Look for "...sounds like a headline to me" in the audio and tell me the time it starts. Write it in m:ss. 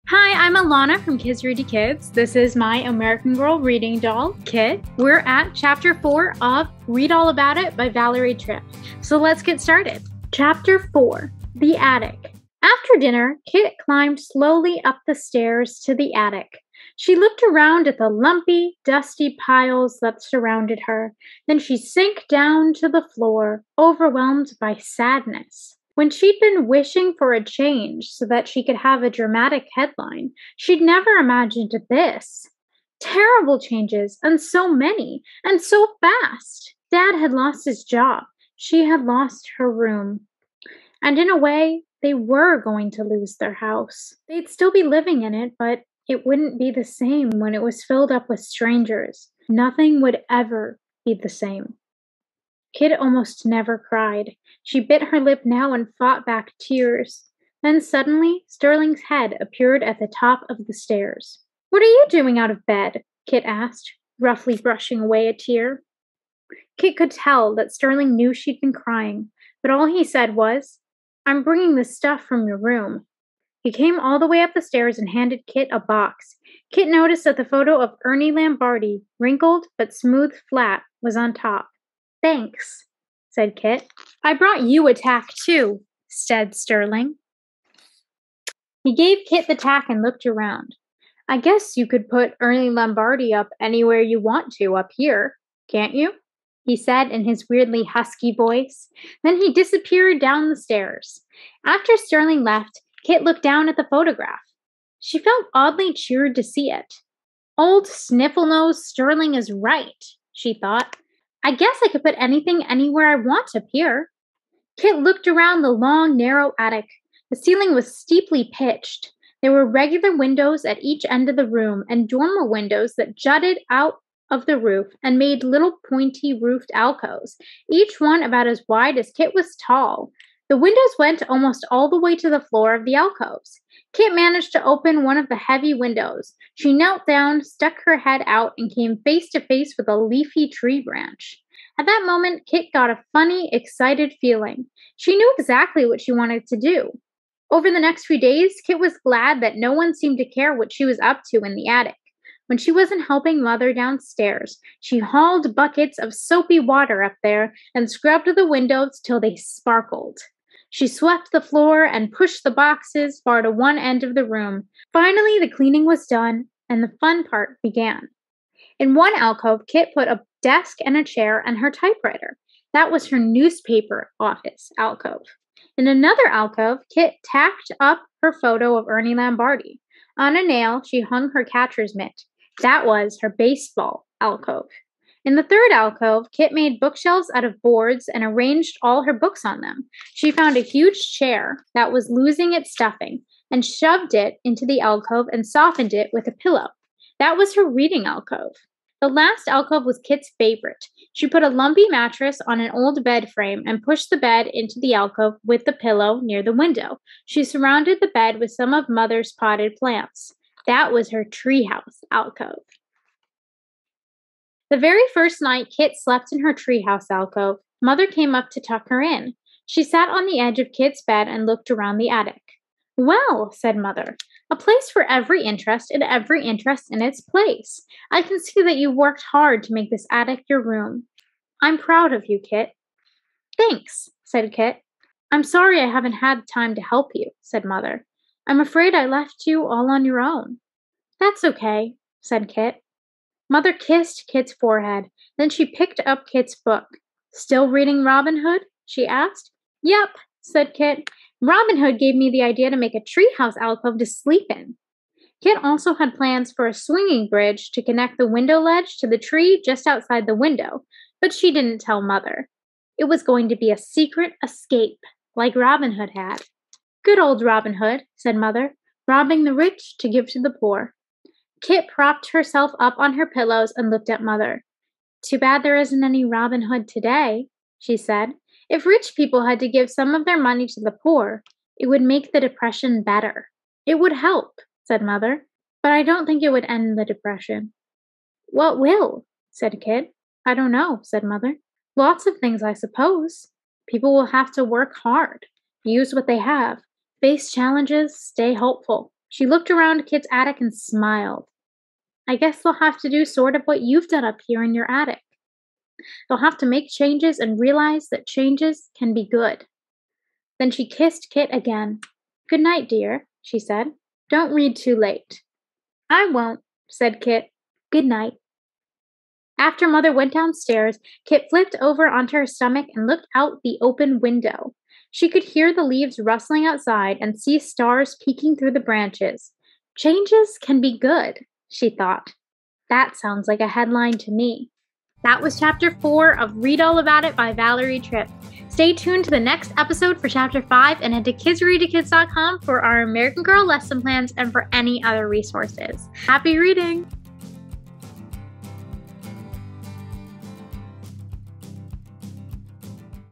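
5:33.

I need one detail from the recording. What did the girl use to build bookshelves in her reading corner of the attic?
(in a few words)
boards.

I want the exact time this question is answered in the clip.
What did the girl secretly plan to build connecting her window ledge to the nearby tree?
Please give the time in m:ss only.
4:16.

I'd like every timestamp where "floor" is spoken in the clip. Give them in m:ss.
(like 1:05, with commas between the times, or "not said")
0:23, 2:12, 2:41.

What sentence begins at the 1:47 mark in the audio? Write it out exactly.
Old Snifflenose Sterling is right, she thought.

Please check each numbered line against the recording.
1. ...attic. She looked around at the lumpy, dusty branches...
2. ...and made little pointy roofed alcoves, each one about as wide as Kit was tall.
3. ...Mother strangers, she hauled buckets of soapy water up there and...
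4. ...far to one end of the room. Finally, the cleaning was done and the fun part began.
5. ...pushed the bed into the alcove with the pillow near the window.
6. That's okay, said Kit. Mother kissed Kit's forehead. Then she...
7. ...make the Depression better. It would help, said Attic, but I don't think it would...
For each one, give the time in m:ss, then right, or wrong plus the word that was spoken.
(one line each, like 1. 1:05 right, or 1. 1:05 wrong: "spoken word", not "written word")
1. 0:16 wrong: "piles", not "branches"
2. 2:05 right
3. 2:33 wrong: "downstairs", not "strangers"
4. 2:43 right
5. 3:23 right
6. 4:01 right
7. 4:42 wrong: "Mother", not "Attic".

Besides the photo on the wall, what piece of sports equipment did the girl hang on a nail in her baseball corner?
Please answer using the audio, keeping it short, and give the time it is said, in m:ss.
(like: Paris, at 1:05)
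catcher's mitt, at 3:01.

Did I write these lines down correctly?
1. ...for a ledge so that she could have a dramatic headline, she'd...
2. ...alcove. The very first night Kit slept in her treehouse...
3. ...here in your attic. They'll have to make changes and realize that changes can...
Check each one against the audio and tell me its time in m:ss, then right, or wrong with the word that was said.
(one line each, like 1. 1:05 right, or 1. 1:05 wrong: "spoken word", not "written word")
1. 0:27 wrong: "change", not "ledge"
2. 3:32 right
3. 5:04 right.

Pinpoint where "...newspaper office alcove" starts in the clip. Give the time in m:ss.
2:53.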